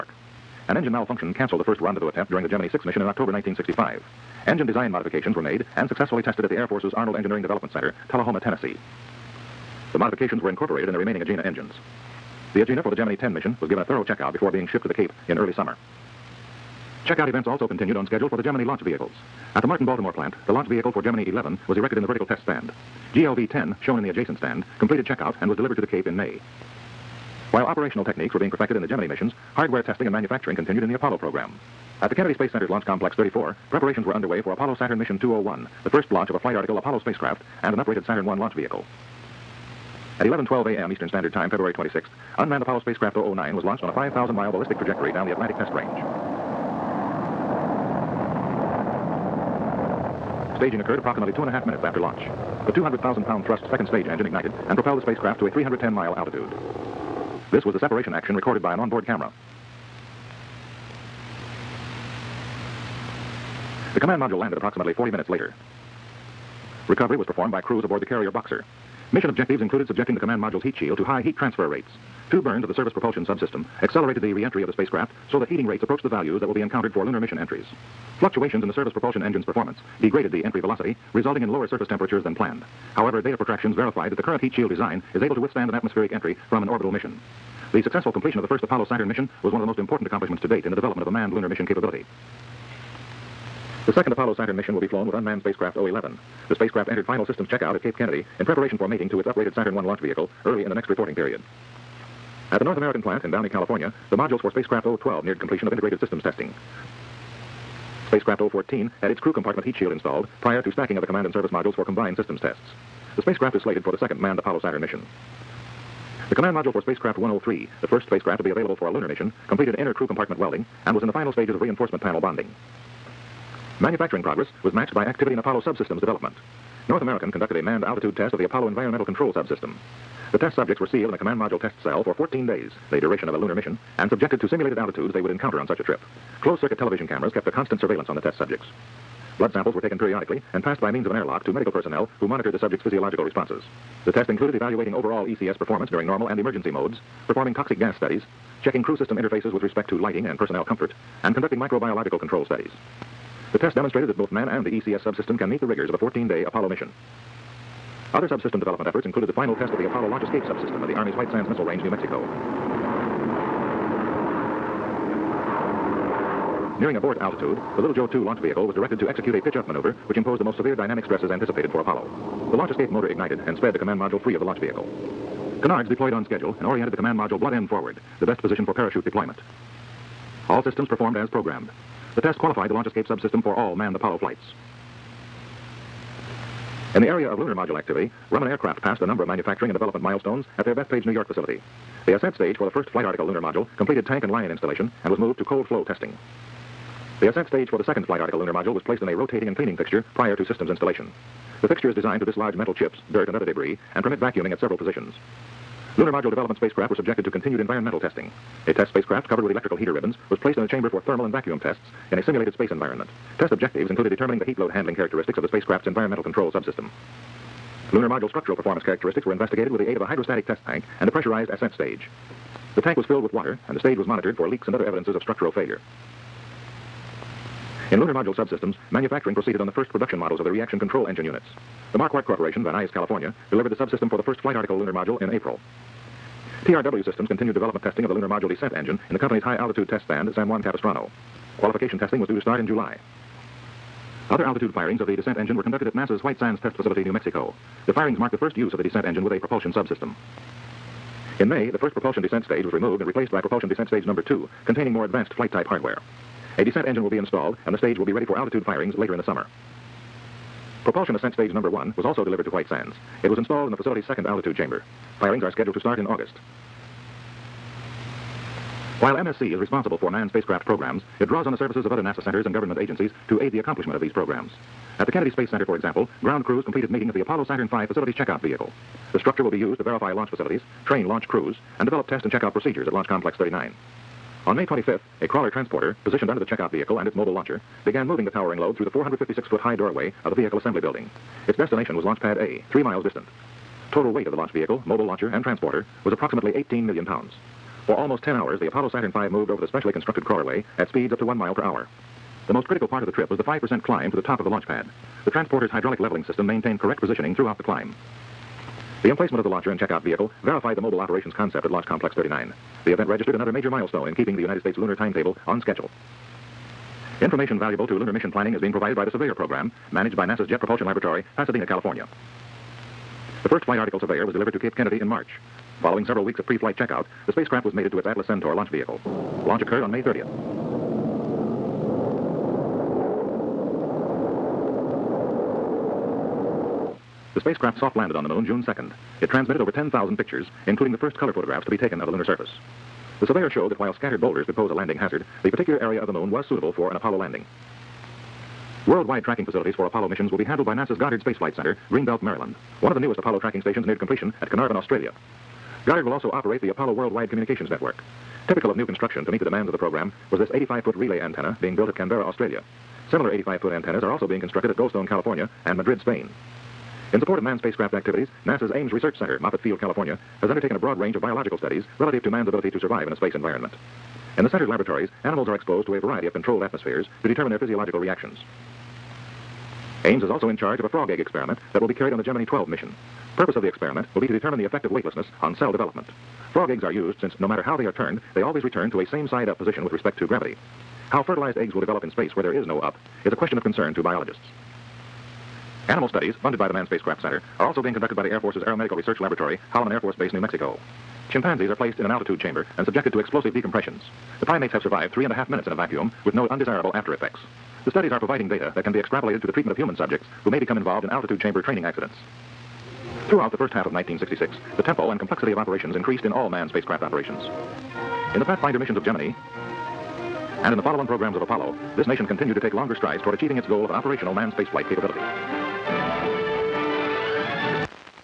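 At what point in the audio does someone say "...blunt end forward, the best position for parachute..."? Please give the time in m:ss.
2:57.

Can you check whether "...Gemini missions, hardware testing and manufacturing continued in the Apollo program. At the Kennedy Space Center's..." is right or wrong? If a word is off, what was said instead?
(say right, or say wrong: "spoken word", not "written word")
right.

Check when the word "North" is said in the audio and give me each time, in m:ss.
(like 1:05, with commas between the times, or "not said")
1:42, 2:06.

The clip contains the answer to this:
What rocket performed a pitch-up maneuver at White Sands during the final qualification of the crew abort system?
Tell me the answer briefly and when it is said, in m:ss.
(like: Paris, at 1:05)
Little Joe 2, at 2:47.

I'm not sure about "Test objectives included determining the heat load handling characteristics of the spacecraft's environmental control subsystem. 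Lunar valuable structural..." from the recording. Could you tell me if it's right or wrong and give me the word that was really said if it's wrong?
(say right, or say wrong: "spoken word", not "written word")
wrong: "module", not "valuable".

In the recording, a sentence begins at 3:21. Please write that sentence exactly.
The fixture is designed to dislodge metal chips, dirt, and other debris, and permit vacuuming at several positions.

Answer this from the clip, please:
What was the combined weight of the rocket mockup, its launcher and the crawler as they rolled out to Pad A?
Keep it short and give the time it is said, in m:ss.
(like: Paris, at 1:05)
18 million pounds, at 4:56.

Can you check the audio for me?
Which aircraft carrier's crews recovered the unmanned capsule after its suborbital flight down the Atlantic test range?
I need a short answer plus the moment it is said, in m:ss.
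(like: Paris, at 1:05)
Boxer, at 1:08.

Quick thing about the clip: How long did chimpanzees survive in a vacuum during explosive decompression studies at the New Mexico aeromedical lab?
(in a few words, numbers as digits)
3 and a half minutes.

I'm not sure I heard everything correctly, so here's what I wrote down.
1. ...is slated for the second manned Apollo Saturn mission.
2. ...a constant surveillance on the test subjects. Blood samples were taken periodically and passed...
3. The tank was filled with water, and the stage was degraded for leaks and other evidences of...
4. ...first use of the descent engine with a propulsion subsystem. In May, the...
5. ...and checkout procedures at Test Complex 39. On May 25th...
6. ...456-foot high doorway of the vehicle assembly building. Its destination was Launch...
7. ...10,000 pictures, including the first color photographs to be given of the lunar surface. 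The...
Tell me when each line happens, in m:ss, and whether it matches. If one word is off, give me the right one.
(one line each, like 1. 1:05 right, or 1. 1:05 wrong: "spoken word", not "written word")
1. 1:53 right
2. 2:17 right
3. 3:42 wrong: "monitored", not "degraded"
4. 4:08 right
5. 4:42 wrong: "Launch", not "Test"
6. 4:48 right
7. 5:39 wrong: "taken", not "given".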